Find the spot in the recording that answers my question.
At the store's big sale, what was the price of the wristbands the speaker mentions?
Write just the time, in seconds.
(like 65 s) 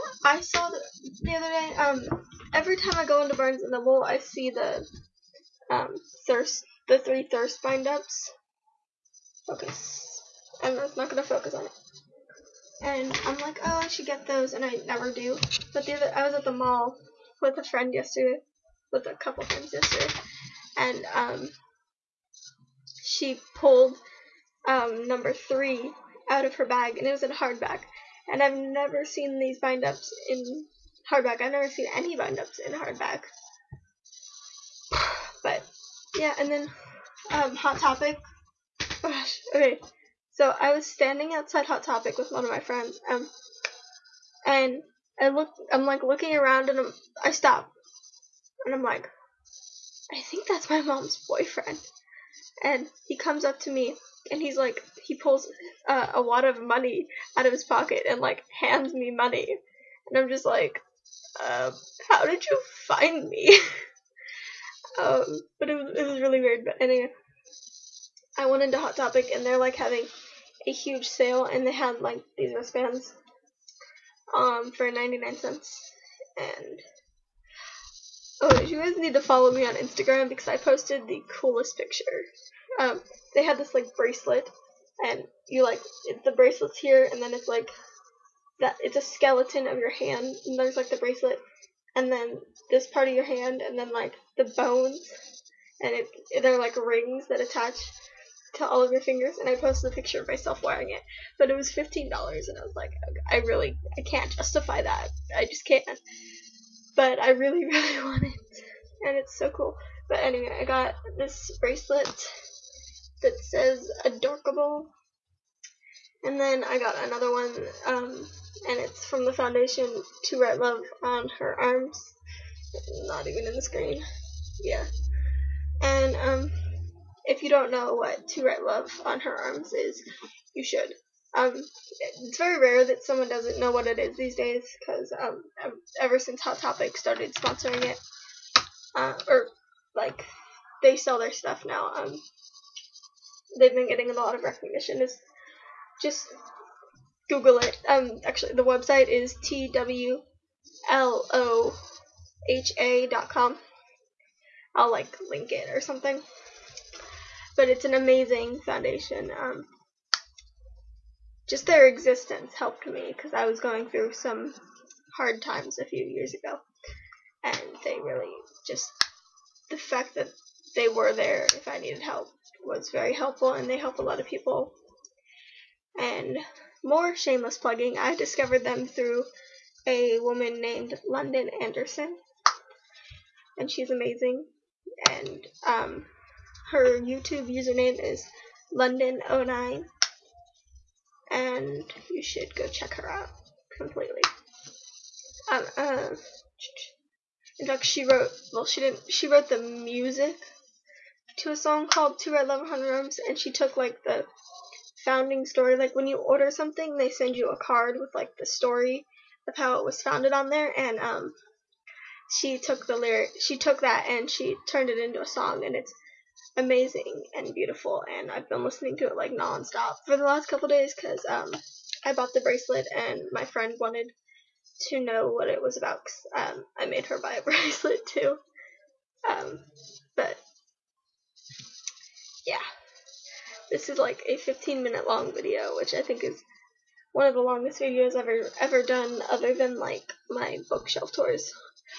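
74 s.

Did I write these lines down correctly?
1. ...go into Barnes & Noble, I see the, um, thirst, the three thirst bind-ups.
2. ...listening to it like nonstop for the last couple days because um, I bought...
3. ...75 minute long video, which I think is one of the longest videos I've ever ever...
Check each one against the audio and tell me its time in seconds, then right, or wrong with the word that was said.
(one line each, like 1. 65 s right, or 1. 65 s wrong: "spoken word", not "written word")
1. 3 s right
2. 218 s right
3. 234 s wrong: "15", not "75".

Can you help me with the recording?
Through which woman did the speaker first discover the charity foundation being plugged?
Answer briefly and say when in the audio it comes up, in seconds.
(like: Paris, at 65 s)
London Anderson, at 181 s.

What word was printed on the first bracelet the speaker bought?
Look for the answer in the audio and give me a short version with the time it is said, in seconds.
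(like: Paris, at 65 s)
Adorkable, at 114 s.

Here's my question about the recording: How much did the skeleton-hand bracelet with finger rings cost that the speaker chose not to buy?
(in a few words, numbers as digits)
15 dollars.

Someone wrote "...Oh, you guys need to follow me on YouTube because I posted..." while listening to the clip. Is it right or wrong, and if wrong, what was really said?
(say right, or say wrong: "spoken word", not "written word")
wrong: "Instagram", not "YouTube".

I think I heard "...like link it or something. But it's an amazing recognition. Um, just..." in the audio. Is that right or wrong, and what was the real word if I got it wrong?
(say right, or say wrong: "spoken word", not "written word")
wrong: "foundation", not "recognition".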